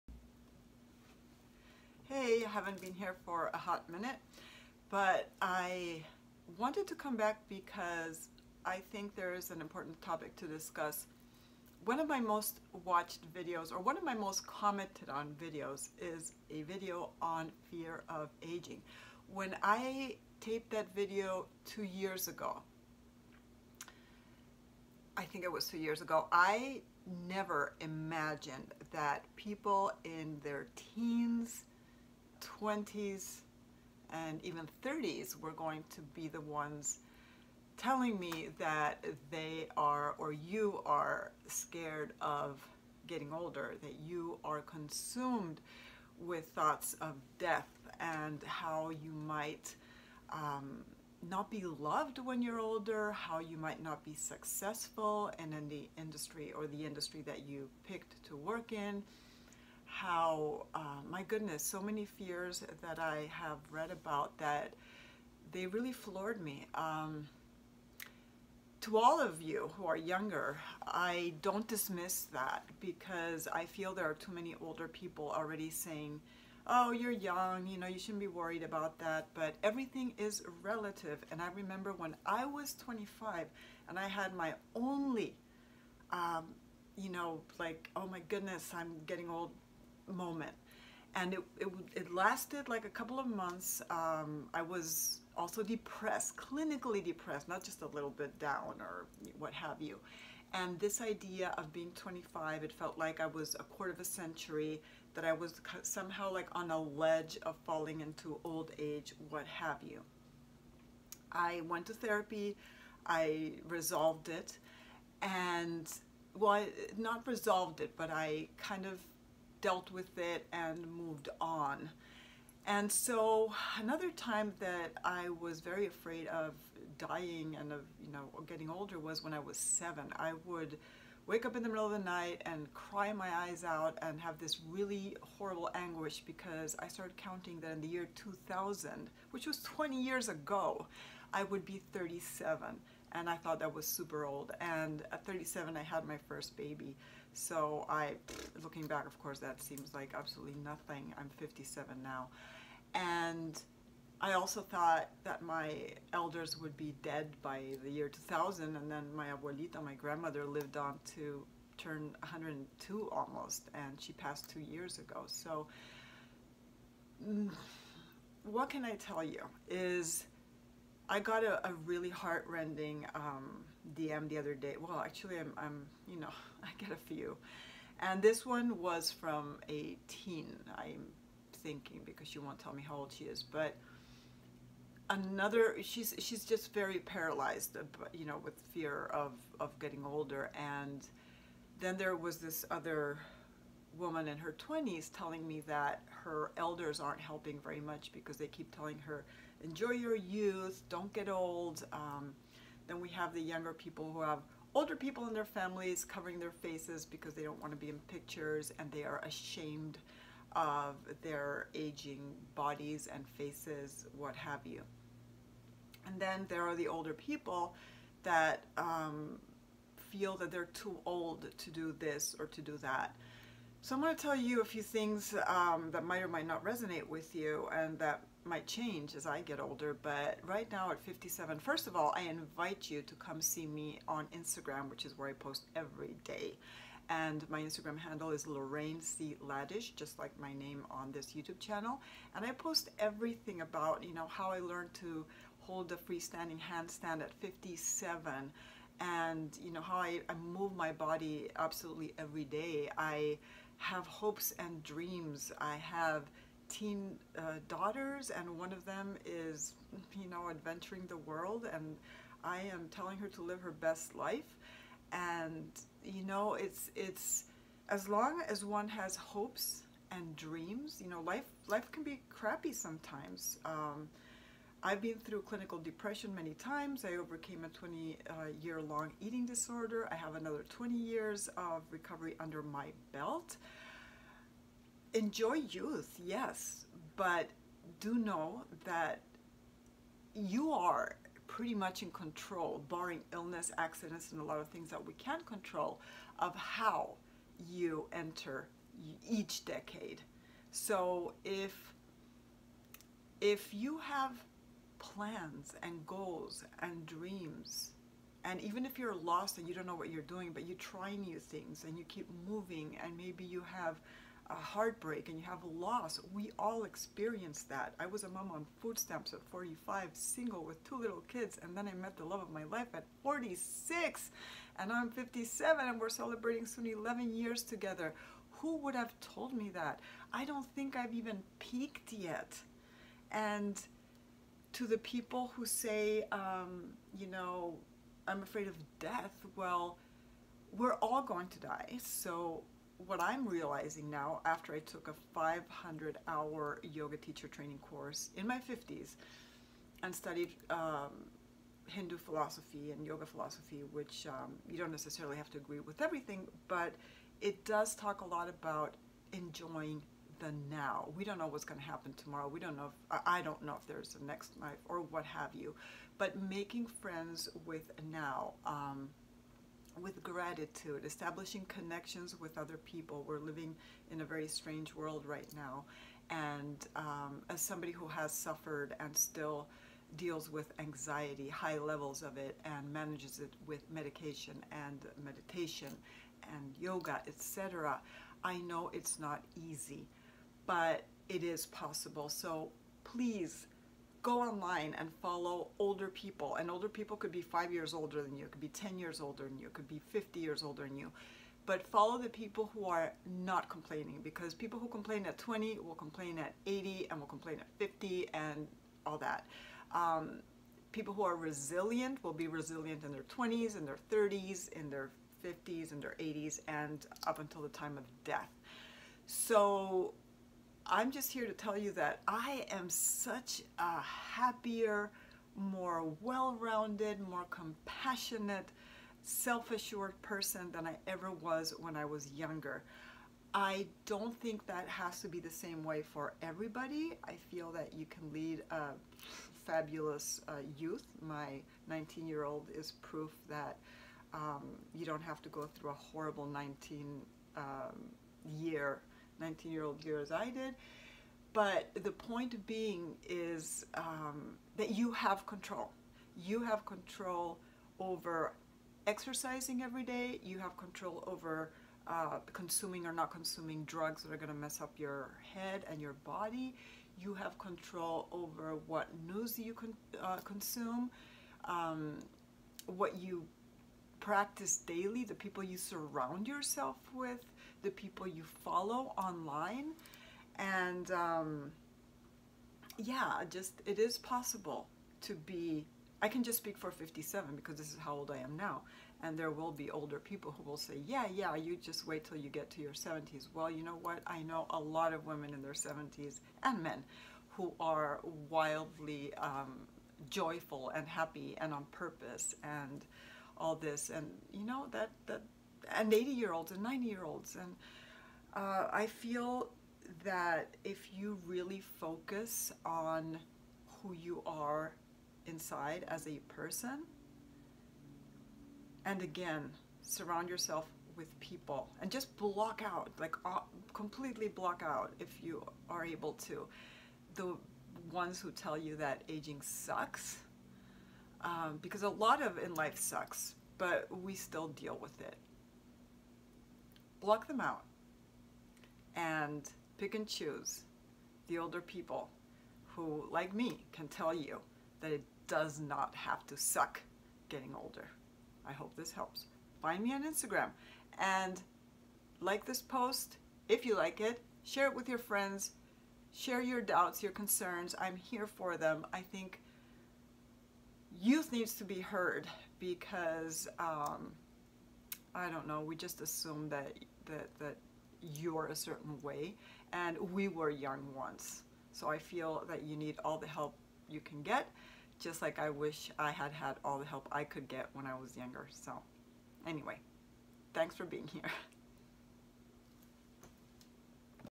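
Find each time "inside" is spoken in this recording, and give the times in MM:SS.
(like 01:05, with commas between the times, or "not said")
08:35.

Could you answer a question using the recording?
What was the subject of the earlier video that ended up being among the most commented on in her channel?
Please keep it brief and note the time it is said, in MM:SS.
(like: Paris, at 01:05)
fear of aging, at 00:17.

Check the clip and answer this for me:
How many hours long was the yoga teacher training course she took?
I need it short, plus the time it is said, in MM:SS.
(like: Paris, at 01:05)
500, at 05:45.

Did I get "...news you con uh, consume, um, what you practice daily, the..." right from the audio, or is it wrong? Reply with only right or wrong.
right.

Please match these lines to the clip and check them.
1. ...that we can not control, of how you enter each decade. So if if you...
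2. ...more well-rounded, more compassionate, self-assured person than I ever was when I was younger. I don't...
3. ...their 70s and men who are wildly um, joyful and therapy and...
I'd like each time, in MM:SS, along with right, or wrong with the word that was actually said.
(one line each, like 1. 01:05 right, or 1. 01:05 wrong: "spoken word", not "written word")
1. 04:54 right
2. 07:05 right
3. 08:15 wrong: "happy", not "therapy".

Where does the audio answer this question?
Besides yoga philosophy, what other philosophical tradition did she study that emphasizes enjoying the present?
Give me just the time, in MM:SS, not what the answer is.
05:51.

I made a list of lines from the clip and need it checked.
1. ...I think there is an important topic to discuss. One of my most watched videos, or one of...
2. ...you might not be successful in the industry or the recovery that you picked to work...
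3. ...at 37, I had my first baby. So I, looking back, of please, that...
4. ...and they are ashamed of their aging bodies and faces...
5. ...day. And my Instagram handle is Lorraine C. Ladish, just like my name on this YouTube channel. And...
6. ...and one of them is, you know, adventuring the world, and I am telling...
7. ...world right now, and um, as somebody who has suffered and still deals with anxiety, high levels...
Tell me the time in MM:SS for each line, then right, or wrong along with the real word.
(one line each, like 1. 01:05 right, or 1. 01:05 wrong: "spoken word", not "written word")
1. 00:08 right
2. 00:53 wrong: "industry", not "recovery"
3. 02:25 wrong: "course", not "please"
4. 03:28 right
5. 03:56 right
6. 04:18 right
7. 06:14 right.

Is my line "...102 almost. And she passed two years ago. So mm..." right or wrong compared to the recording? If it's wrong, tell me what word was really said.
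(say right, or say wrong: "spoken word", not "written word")
right.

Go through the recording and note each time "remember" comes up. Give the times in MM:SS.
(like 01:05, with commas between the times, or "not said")
01:21.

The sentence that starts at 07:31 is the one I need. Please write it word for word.
But the point being is um, that you have control.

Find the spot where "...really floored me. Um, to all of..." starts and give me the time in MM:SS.
01:05.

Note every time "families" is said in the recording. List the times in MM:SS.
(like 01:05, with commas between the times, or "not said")
03:25.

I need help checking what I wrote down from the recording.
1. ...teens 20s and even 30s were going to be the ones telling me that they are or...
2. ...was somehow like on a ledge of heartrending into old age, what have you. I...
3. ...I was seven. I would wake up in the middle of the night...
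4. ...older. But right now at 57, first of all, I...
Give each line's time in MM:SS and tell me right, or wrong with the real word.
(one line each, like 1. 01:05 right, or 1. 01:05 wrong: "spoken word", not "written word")
1. 00:30 right
2. 01:45 wrong: "falling", not "heartrending"
3. 02:09 right
4. 03:49 right.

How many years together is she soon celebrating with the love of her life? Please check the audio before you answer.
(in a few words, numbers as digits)
11 years.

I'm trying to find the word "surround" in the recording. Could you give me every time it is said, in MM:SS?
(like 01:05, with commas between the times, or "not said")
07:55, 08:40.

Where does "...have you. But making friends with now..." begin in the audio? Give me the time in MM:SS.
06:05.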